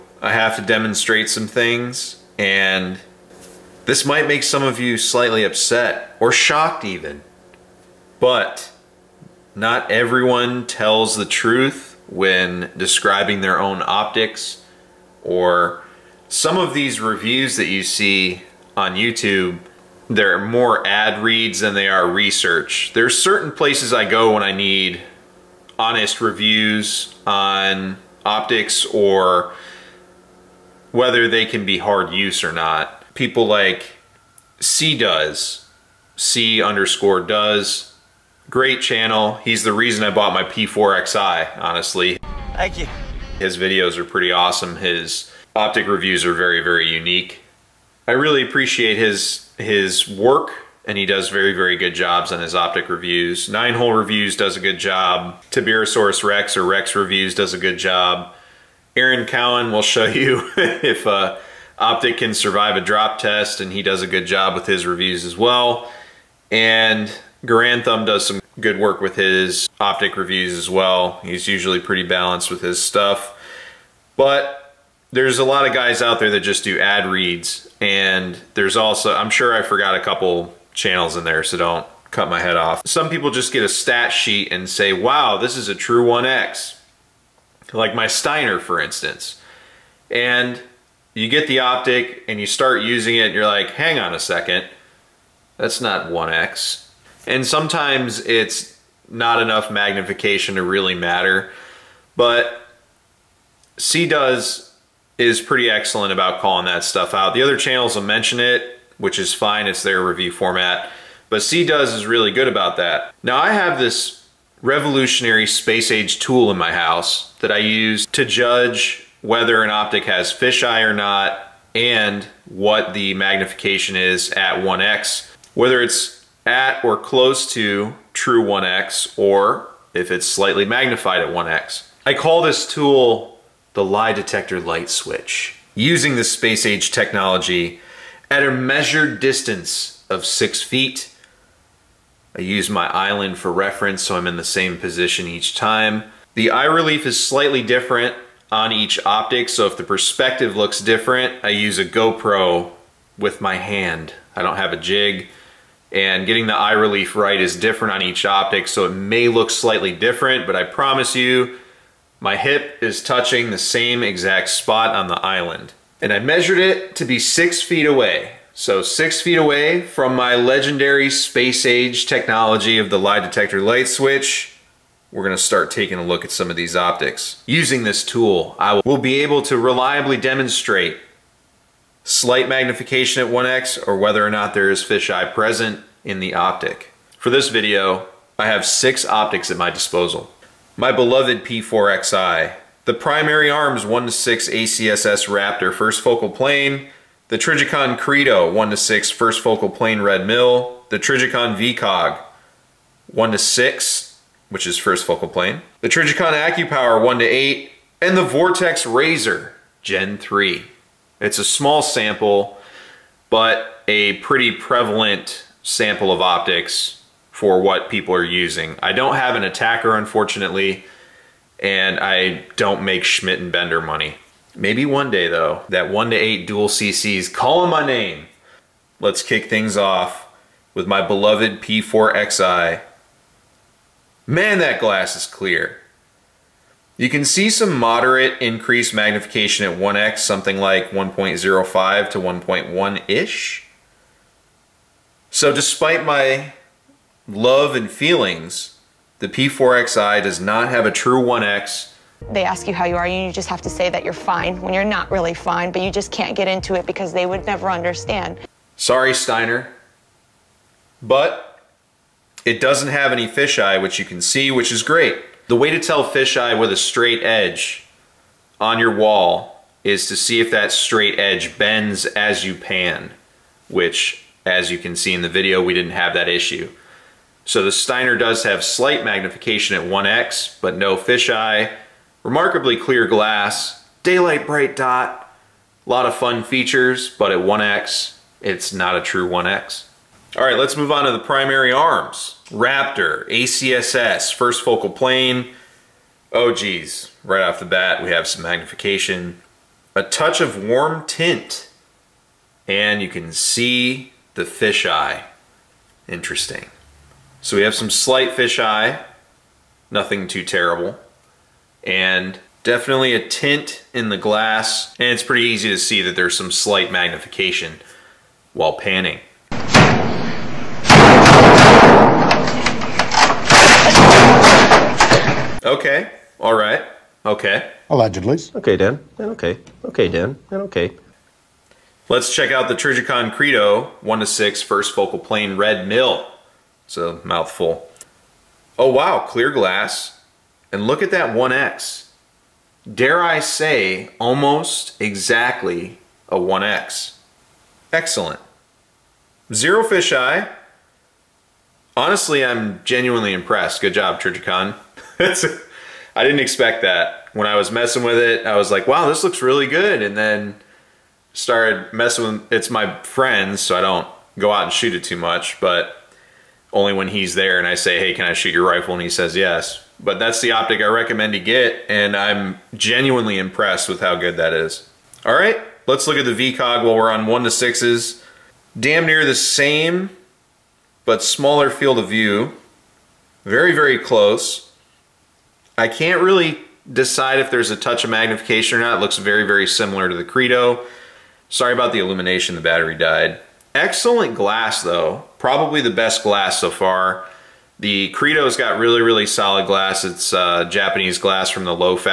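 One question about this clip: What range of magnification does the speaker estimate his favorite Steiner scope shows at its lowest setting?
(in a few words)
1.05 to 1.1.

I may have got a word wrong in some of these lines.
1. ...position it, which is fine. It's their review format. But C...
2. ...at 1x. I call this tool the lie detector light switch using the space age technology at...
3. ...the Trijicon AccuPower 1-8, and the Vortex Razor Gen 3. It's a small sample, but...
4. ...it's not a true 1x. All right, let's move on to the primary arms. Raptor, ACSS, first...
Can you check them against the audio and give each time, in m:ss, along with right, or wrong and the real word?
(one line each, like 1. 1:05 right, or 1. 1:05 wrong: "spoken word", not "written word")
1. 1:48 wrong: "mention", not "position"
2. 2:11 right
3. 3:25 right
4. 4:48 right.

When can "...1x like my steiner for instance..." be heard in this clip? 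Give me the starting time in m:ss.
1:26.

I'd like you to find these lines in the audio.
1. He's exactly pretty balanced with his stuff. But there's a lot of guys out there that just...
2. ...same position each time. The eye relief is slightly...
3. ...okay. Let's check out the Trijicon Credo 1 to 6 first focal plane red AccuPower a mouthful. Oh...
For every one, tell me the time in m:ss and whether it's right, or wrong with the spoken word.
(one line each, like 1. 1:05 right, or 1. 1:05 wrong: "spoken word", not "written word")
1. 1:11 wrong: "usually", not "exactly"
2. 2:24 right
3. 5:30 wrong: "MIL", not "AccuPower".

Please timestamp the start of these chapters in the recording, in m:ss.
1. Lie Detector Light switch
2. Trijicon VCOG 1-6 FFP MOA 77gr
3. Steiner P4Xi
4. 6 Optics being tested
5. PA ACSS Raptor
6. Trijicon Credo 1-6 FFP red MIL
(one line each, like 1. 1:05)
1. 1:53
2. 6:14
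3. 3:51
4. 3:07
5. 4:50
6. 5:25.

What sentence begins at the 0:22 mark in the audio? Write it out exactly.
There's certain places I go when I need honest reviews on optics or whether they can be hard use or not.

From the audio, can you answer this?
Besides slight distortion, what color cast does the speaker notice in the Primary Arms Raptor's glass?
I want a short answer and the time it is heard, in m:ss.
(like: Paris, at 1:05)
warm tint, at 5:00.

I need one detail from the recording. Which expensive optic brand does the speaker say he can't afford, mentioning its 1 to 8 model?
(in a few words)
Schmidt and Bender.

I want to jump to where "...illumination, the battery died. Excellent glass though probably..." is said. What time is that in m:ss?
6:31.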